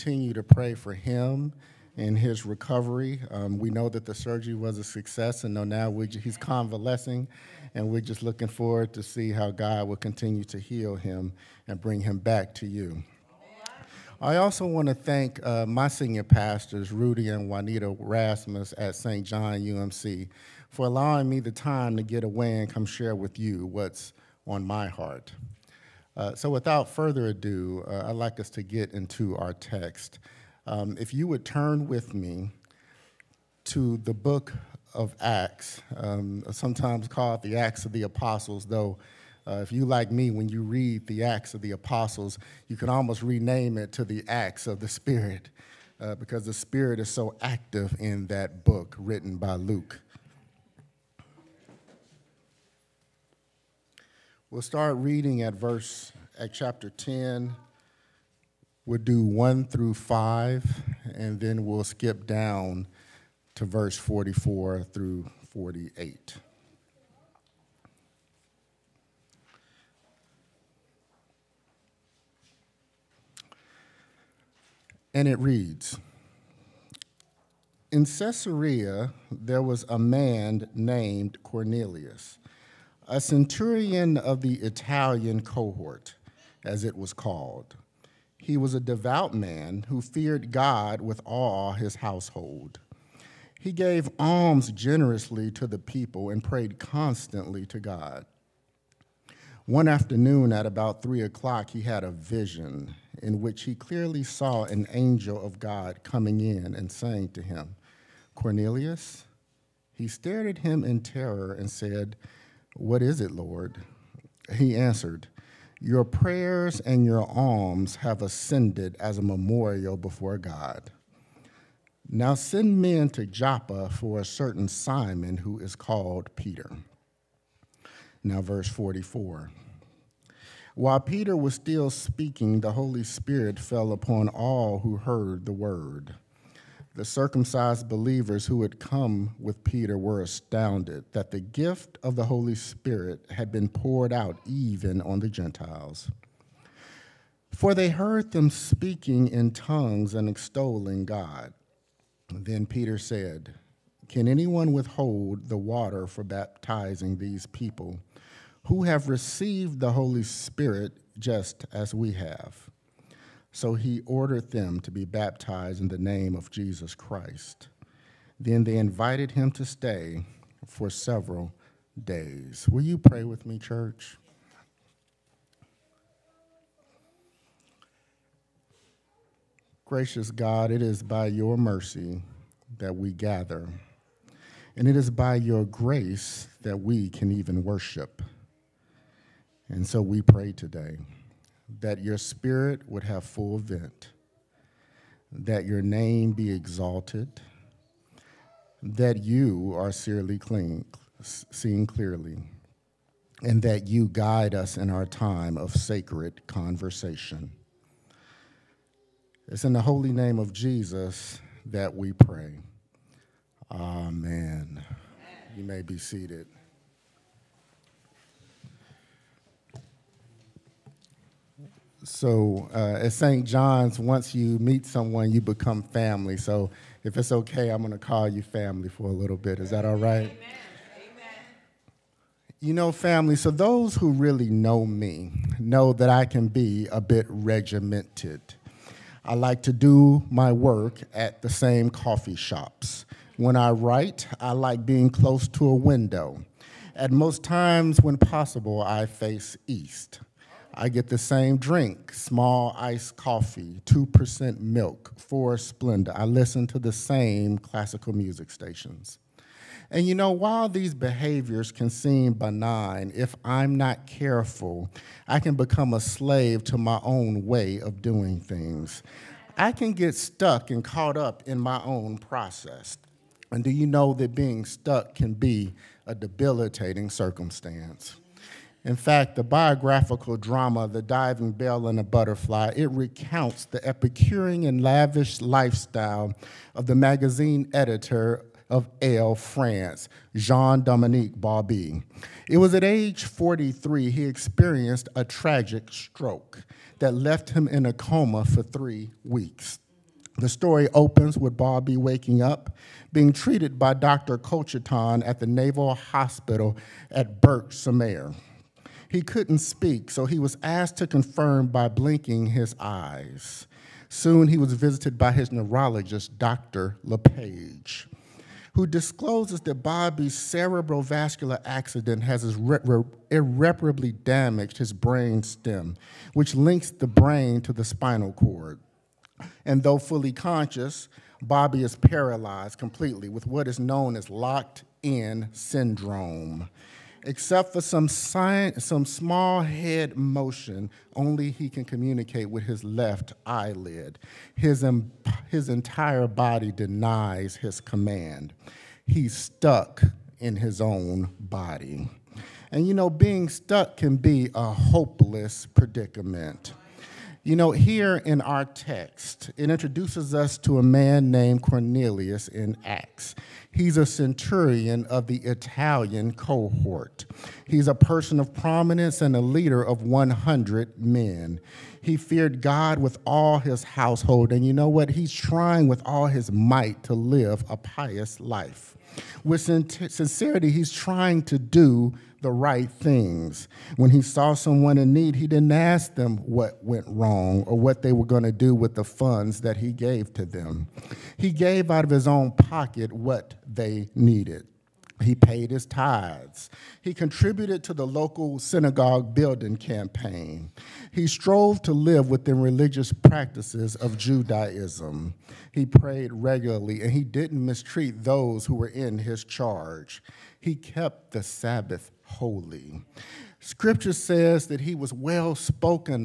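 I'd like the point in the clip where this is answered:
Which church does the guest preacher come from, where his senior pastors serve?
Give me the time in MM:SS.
00:18.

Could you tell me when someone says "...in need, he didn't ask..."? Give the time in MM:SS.
06:24.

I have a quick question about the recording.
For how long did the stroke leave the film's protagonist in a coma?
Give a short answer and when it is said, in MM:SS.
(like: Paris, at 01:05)
3 weeks, at 04:58.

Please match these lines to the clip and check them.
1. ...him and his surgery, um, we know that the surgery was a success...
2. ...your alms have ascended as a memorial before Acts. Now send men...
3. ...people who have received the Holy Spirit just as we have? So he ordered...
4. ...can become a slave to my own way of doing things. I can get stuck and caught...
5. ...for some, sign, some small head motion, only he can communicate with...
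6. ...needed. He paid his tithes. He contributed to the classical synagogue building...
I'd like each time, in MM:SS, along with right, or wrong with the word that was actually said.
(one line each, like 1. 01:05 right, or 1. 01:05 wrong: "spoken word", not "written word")
1. 00:00 wrong: "recovery", not "surgery"
2. 01:57 wrong: "God", not "Acts"
3. 02:37 right
4. 04:25 right
5. 05:37 right
6. 06:34 wrong: "local", not "classical".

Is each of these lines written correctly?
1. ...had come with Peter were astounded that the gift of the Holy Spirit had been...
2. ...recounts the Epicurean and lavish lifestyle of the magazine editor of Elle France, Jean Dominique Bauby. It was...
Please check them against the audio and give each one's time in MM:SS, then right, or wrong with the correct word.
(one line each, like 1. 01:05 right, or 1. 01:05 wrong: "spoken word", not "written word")
1. 02:18 right
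2. 04:42 right.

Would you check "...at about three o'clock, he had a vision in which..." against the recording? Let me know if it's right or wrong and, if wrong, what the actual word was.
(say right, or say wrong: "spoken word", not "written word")
right.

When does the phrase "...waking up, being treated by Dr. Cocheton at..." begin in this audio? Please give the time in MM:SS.
05:01.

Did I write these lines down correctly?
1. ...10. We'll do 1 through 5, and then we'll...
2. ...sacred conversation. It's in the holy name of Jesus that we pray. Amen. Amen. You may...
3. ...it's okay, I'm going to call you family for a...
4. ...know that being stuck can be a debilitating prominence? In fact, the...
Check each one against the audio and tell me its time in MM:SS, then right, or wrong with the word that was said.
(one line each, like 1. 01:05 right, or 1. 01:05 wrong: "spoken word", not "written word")
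1. 00:56 right
2. 03:25 right
3. 03:47 right
4. 04:33 wrong: "circumstance", not "prominence".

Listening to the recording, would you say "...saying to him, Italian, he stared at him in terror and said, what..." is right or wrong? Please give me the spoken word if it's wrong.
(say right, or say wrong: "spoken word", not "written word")
wrong: "Cornelius", not "Italian".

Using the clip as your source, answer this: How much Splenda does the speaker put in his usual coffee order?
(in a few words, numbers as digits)
4.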